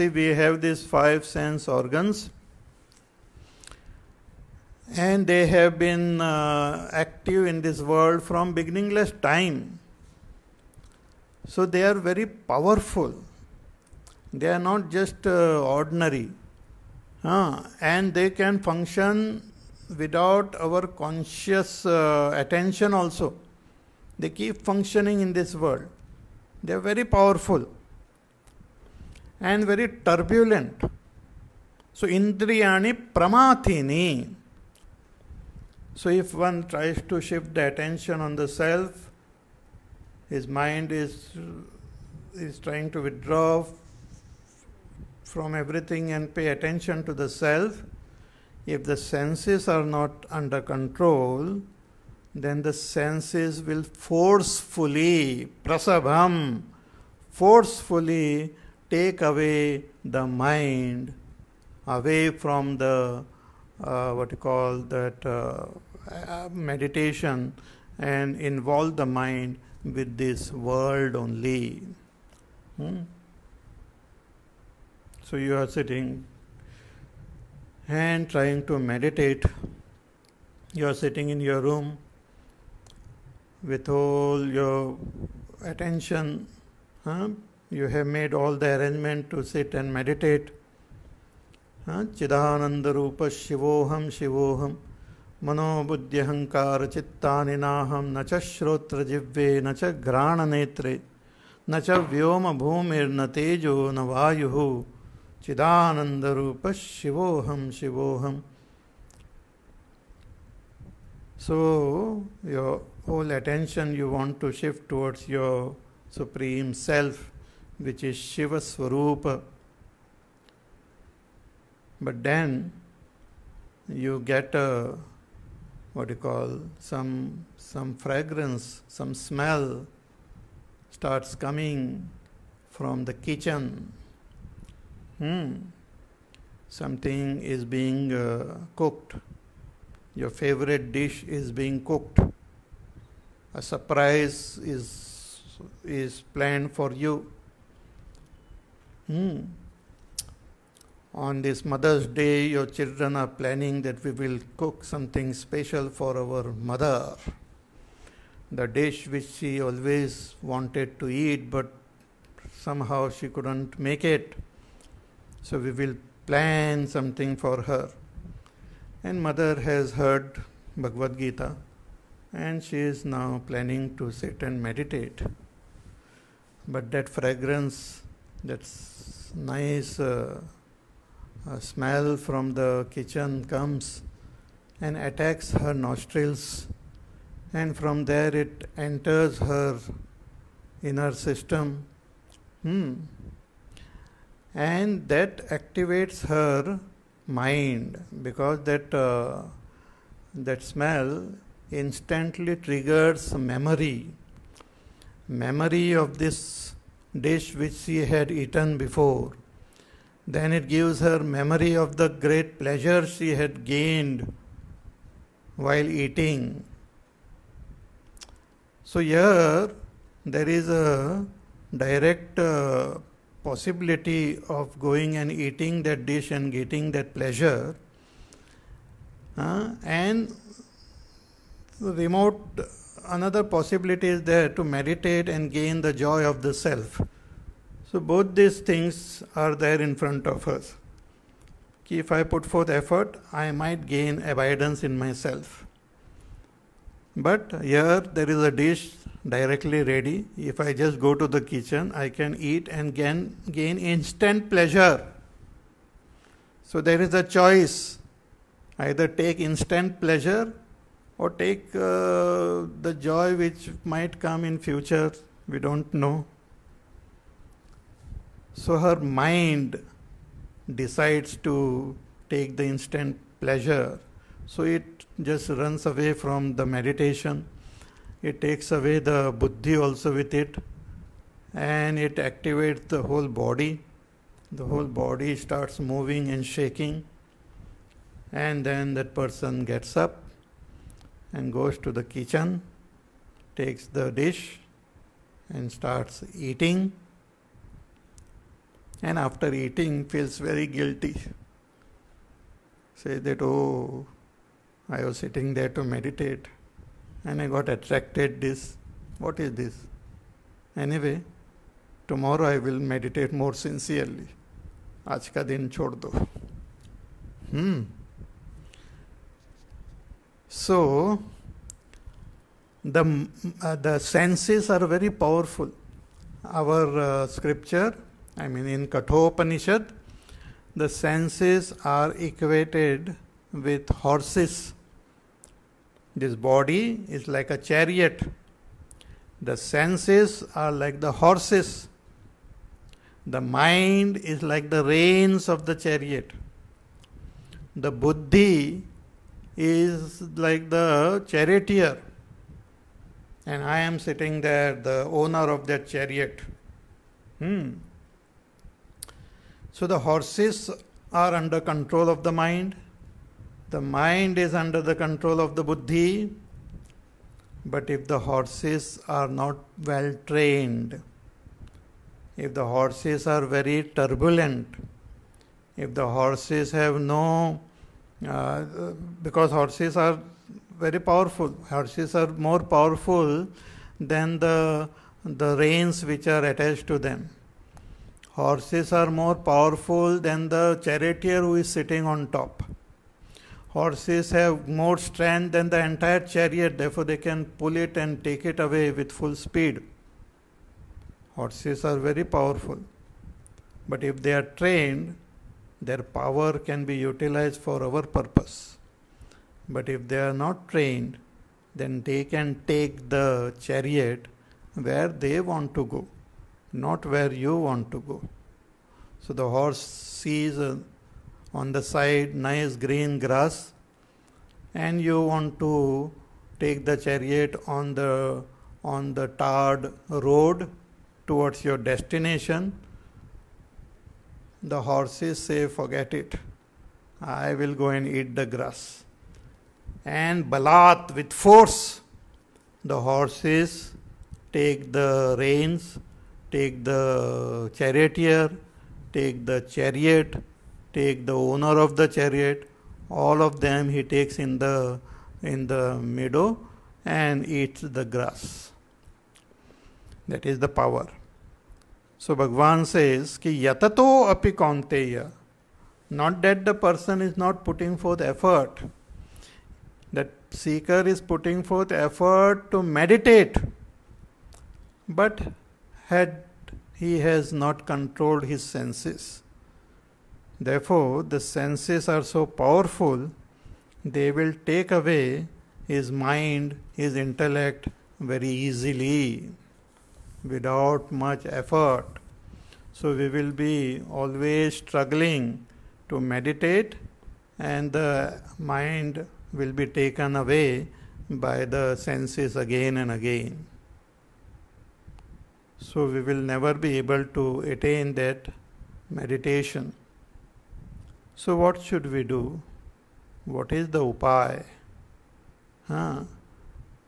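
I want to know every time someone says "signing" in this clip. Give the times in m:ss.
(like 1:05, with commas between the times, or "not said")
not said.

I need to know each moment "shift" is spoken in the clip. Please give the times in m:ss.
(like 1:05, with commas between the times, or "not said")
0:37, 1:54.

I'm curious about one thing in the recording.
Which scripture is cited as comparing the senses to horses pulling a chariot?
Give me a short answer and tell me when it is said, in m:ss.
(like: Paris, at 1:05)
Kathopanishad, at 5:28.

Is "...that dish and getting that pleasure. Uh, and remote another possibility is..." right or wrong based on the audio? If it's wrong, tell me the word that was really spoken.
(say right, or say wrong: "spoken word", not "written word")
right.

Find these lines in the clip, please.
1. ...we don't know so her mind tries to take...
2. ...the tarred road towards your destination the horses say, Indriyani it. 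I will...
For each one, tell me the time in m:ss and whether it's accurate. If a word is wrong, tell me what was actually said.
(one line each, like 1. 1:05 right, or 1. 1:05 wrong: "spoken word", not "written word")
1. 4:25 wrong: "decides", not "tries"
2. 7:09 wrong: "Forget", not "Indriyani".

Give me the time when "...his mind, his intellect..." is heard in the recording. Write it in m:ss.
8:05.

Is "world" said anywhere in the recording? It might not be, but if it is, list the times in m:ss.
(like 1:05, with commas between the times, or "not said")
0:07, 0:25, 1:10.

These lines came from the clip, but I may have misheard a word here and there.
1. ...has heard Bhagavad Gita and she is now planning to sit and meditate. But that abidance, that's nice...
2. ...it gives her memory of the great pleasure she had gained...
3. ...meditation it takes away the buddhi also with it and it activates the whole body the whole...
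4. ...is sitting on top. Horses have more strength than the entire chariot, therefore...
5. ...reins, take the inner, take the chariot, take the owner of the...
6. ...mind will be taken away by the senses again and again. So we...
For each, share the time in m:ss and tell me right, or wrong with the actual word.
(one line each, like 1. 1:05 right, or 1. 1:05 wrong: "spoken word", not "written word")
1. 2:49 wrong: "fragrance", not "abidance"
2. 3:30 right
3. 4:36 right
4. 6:31 right
5. 7:25 wrong: "charioteer", not "inner"
6. 8:18 right.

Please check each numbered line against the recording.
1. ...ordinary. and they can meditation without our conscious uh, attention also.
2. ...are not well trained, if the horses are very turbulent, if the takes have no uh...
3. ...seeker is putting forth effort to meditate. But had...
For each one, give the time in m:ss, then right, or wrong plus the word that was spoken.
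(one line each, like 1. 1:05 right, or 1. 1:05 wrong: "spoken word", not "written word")
1. 0:15 wrong: "function", not "meditation"
2. 6:09 wrong: "horses", not "takes"
3. 7:50 right.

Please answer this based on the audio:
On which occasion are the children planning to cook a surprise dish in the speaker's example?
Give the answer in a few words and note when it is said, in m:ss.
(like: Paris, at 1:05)
Mother's Day, at 2:31.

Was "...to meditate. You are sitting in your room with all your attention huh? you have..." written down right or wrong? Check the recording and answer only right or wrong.
right.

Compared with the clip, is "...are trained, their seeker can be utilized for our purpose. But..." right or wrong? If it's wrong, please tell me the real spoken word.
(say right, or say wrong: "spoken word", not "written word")
wrong: "power", not "seeker".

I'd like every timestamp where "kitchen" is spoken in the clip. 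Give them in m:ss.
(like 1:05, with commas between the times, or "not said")
2:13, 3:02, 4:11, 4:52.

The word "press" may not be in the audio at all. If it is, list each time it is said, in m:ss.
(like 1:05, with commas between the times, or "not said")
not said.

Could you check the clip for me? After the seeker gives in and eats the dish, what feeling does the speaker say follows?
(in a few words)
guilty.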